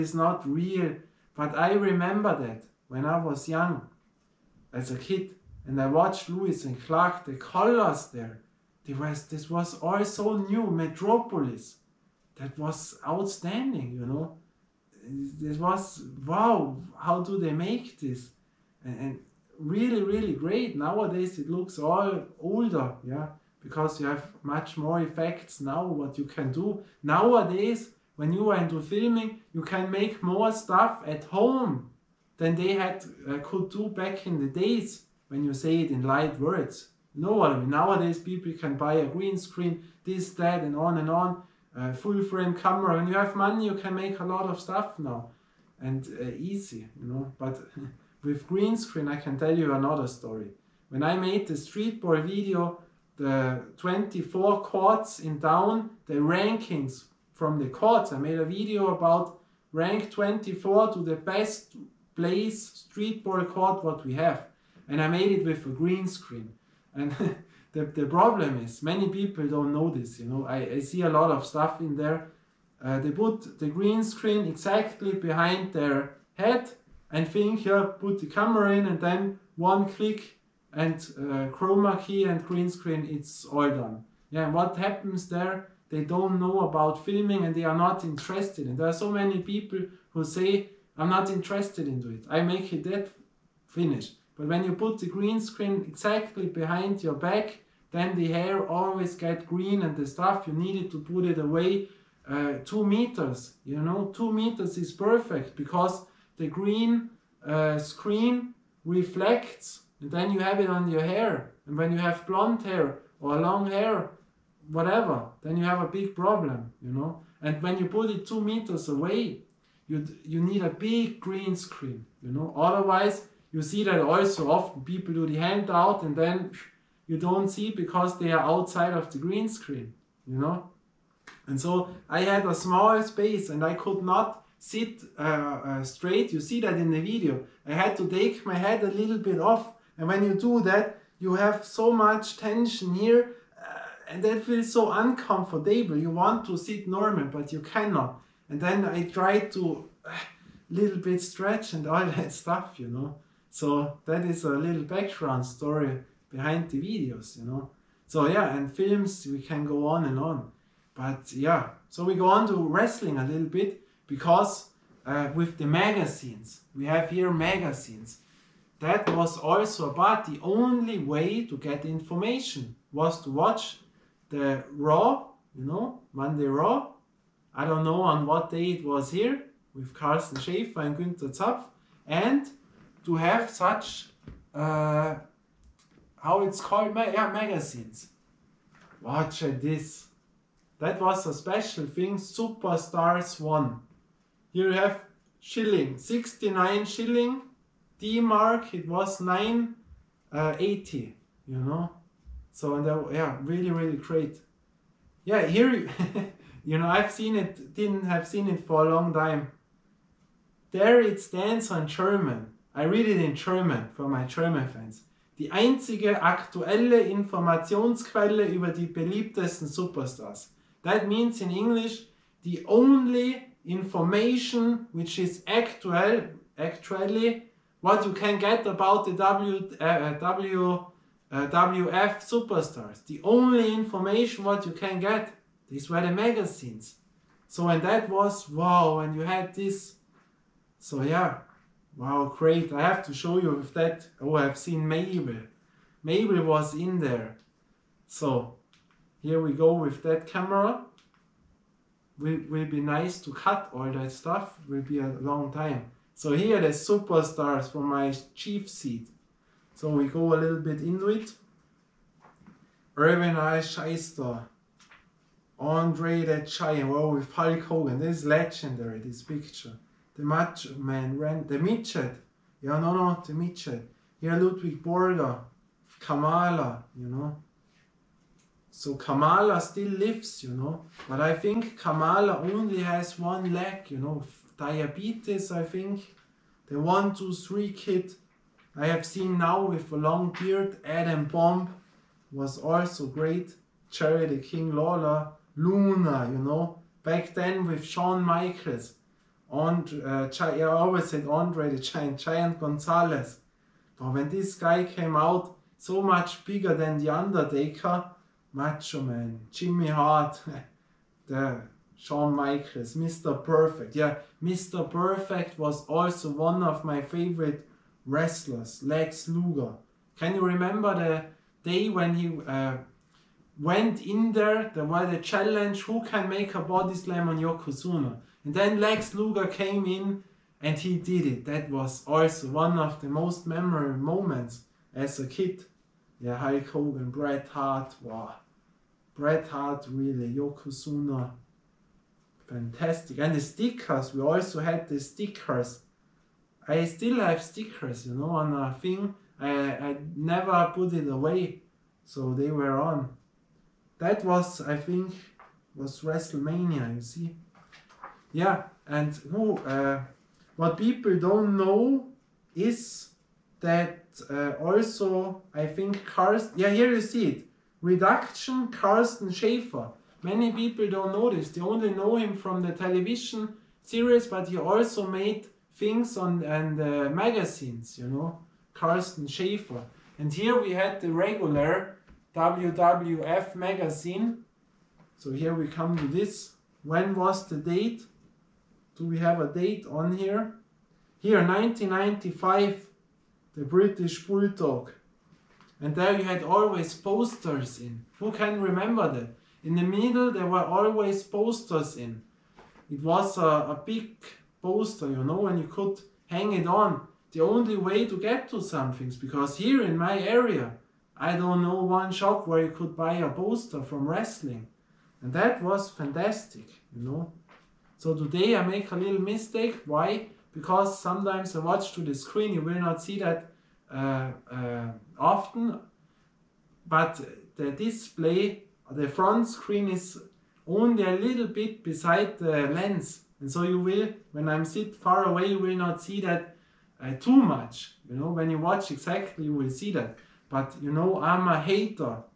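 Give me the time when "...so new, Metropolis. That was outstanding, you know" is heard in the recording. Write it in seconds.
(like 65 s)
10 s.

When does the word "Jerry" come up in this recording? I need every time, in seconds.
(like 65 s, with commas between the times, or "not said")
293 s.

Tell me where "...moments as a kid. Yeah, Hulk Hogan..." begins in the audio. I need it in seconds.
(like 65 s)
333 s.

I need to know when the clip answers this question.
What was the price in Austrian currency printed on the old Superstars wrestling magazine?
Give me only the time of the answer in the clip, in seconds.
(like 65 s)
195 s.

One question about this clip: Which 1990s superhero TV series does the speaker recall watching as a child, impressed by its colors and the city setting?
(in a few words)
Lois and Clark.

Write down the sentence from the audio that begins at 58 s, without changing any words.
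I made a video about rank 24 to the best place street ball court.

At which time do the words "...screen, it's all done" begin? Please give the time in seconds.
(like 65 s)
82 s.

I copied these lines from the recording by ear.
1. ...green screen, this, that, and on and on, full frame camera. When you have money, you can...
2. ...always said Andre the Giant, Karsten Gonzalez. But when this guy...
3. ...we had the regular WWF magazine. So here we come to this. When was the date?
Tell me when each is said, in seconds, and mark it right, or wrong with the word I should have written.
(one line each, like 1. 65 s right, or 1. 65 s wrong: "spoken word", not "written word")
1. 39 s right
2. 300 s wrong: "Giant", not "Karsten"
3. 380 s right.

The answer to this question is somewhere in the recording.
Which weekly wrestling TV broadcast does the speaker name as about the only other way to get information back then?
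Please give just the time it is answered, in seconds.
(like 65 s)
176 s.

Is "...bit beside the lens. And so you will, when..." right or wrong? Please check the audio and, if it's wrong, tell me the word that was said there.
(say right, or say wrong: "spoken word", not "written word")
right.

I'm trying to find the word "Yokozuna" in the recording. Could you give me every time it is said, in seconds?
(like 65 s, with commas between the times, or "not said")
327 s, 340 s.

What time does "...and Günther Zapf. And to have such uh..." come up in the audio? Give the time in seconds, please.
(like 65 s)
180 s.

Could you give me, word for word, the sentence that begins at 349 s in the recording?
I, I never put it away, so they were on.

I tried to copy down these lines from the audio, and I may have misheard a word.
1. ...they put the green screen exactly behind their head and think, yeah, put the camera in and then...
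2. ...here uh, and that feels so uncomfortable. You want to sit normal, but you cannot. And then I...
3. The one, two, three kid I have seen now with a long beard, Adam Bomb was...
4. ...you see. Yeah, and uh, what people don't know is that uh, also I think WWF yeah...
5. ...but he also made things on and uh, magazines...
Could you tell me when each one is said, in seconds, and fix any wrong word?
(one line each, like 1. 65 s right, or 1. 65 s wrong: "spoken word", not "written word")
1. 72 s right
2. 142 s right
3. 286 s right
4. 356 s wrong: "Karsten", not "WWF"
5. 374 s right.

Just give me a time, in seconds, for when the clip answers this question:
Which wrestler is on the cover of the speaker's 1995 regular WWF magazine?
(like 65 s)
393 s.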